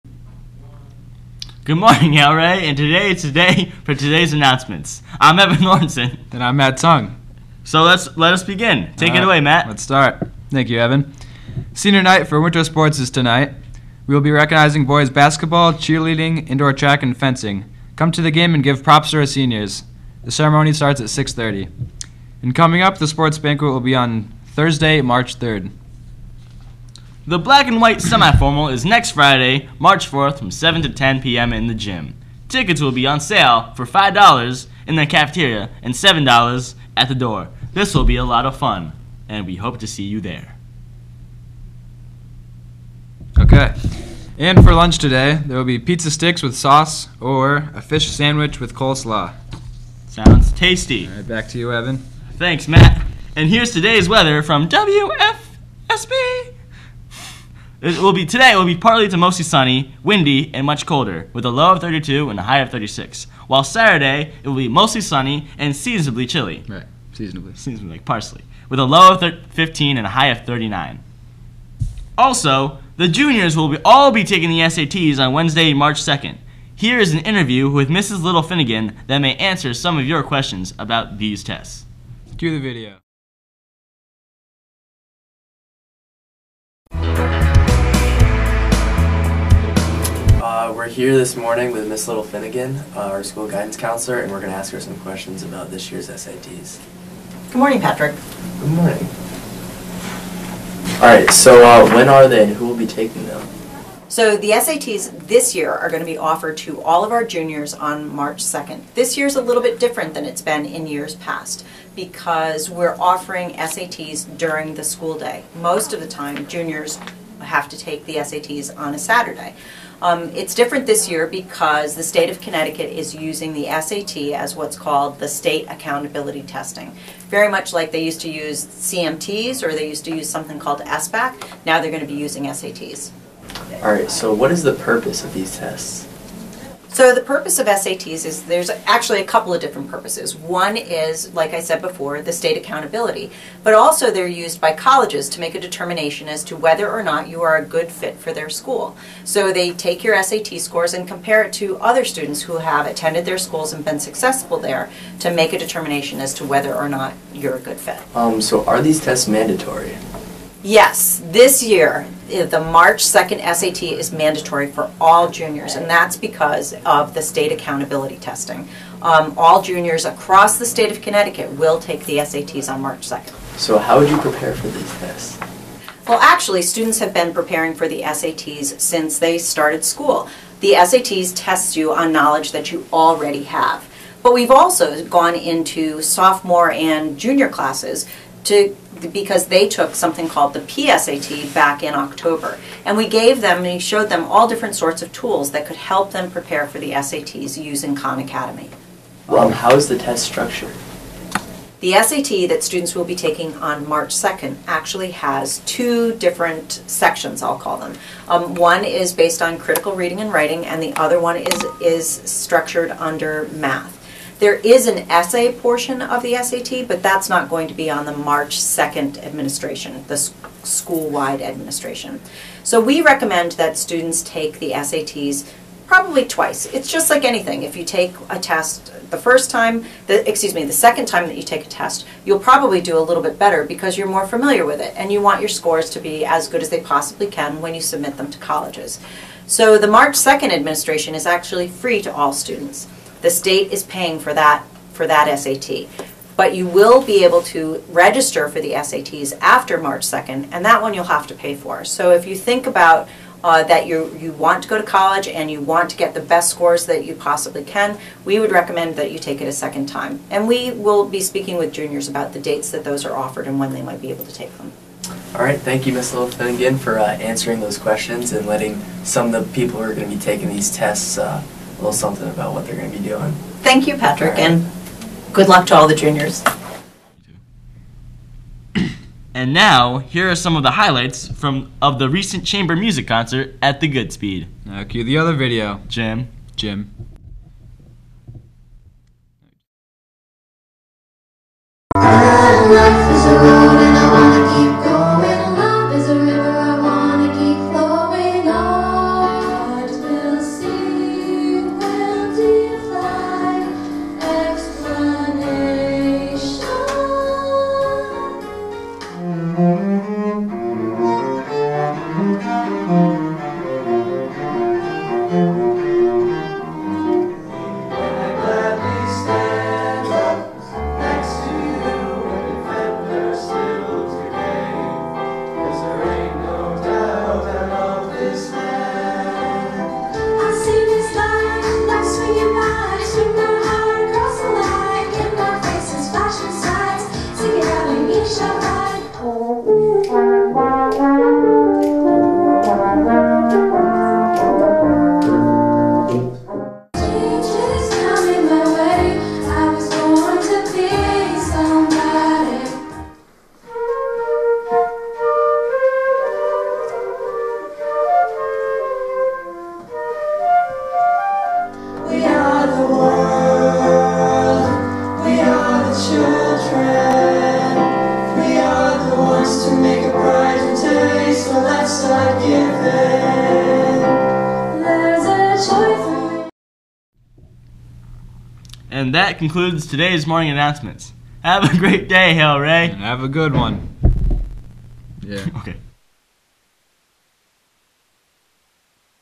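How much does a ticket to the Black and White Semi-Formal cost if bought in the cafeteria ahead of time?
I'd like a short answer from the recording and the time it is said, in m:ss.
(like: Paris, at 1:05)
$5, at 0:33.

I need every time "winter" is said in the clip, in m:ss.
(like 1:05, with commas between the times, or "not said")
0:12.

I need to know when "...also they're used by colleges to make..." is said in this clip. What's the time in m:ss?
2:23.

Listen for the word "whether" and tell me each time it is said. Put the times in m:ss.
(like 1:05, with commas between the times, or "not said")
2:26, 2:36.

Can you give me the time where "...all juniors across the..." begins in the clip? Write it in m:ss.
2:49.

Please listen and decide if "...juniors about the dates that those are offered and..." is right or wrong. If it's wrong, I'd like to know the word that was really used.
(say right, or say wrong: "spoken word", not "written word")
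right.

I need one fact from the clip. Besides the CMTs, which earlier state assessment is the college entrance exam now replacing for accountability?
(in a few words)
SBAC.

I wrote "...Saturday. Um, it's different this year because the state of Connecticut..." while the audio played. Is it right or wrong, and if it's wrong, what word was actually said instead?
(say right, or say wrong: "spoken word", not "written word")
right.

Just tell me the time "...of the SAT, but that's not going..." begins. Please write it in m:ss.
3:36.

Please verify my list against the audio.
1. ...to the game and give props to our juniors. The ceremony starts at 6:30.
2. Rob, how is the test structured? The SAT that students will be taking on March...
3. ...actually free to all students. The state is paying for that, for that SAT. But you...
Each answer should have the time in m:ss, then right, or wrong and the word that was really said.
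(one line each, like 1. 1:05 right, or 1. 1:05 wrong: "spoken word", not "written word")
1. 0:18 wrong: "seniors", not "juniors"
2. 3:19 right
3. 4:01 right.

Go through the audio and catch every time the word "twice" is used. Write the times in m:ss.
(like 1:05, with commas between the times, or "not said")
3:46.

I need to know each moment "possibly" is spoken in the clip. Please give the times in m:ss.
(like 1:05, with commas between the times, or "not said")
3:56, 4:17.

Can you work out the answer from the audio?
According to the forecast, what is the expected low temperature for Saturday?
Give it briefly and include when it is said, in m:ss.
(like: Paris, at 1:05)
15, at 1:09.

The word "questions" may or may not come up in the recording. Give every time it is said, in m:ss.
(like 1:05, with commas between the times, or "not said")
1:20, 1:35, 4:27.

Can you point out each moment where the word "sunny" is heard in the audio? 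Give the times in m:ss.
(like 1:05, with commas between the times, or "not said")
0:59, 1:05.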